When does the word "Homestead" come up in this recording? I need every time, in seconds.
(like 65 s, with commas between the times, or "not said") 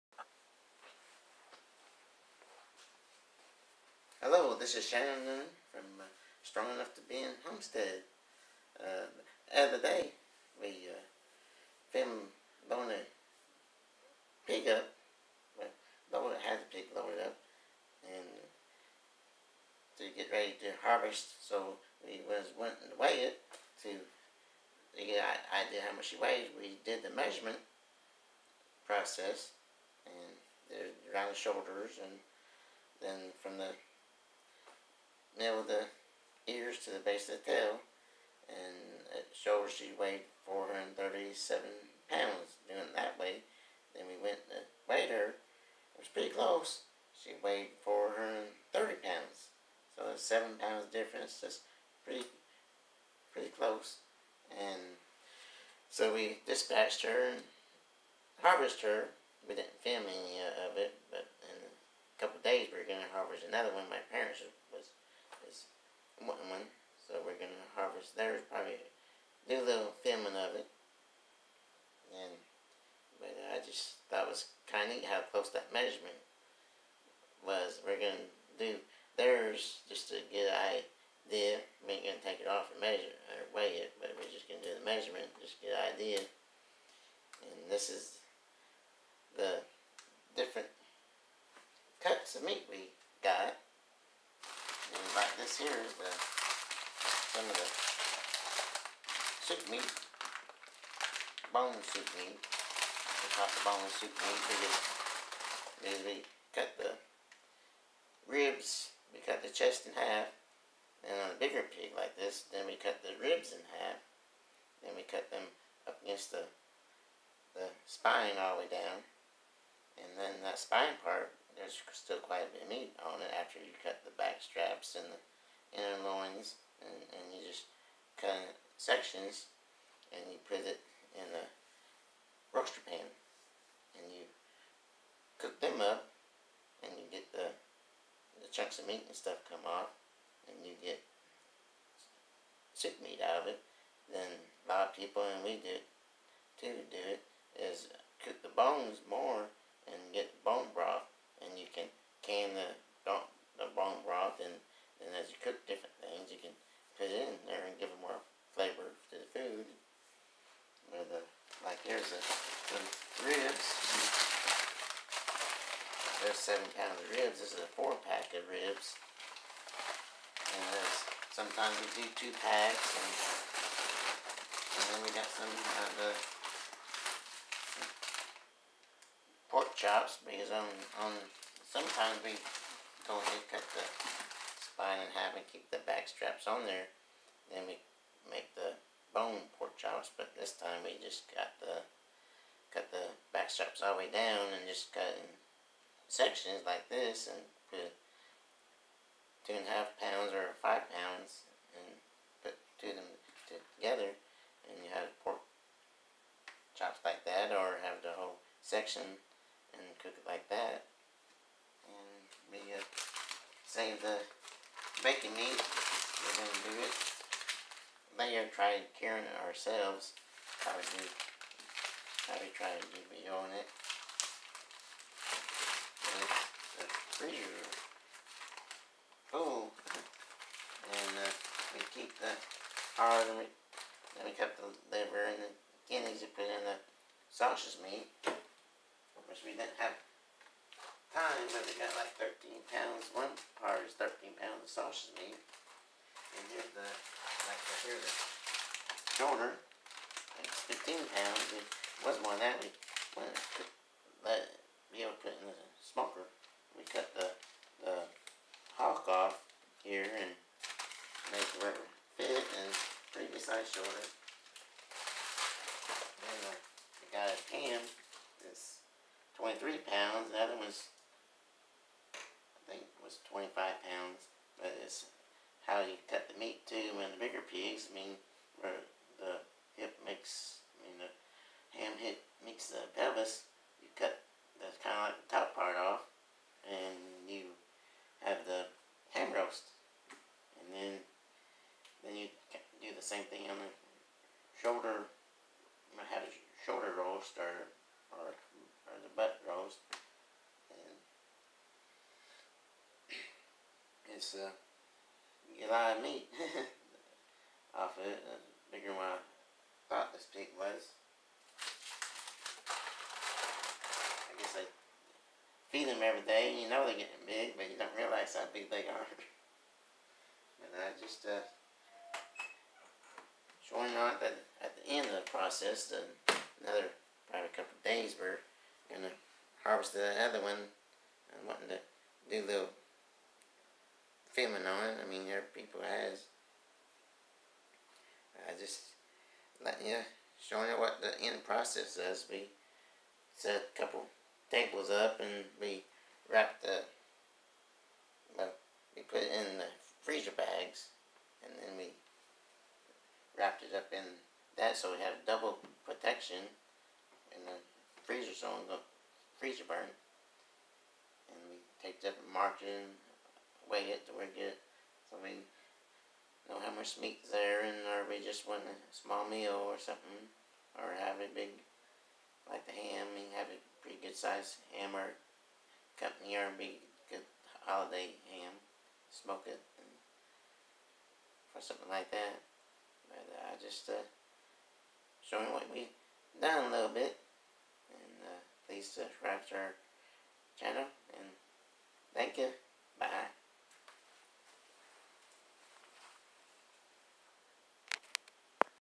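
7 s.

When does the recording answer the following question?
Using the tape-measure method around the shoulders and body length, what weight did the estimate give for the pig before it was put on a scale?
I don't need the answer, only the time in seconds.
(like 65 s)
40 s.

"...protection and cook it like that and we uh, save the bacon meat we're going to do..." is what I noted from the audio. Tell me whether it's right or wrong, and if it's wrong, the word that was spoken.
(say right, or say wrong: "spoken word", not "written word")
wrong: "section", not "protection".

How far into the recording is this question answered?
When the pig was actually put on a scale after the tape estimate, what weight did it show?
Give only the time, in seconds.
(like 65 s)
47 s.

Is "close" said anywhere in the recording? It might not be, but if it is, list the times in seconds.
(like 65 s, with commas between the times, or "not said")
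46 s, 53 s, 75 s.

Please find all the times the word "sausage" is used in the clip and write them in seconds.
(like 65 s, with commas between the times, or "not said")
237 s, 244 s.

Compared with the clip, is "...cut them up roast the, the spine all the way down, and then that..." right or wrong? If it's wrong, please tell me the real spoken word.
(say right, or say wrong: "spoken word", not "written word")
wrong: "against", not "roast".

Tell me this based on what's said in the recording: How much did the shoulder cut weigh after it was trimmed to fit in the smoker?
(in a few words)
15 pounds.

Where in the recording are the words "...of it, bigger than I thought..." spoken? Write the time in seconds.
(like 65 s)
308 s.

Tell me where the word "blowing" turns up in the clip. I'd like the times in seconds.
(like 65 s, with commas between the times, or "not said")
12 s.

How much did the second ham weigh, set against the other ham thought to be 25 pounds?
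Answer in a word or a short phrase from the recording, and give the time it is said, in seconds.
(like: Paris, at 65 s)
23 pounds, at 269 s.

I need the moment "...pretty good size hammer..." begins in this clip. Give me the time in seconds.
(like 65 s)
373 s.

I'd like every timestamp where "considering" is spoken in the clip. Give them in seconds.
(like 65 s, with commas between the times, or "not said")
not said.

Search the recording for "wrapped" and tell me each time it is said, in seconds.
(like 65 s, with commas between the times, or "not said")
346 s, 353 s.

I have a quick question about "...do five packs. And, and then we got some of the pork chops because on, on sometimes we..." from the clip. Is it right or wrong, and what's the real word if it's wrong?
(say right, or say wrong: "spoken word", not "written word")
wrong: "two", not "five".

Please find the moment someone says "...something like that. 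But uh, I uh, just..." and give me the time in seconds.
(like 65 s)
381 s.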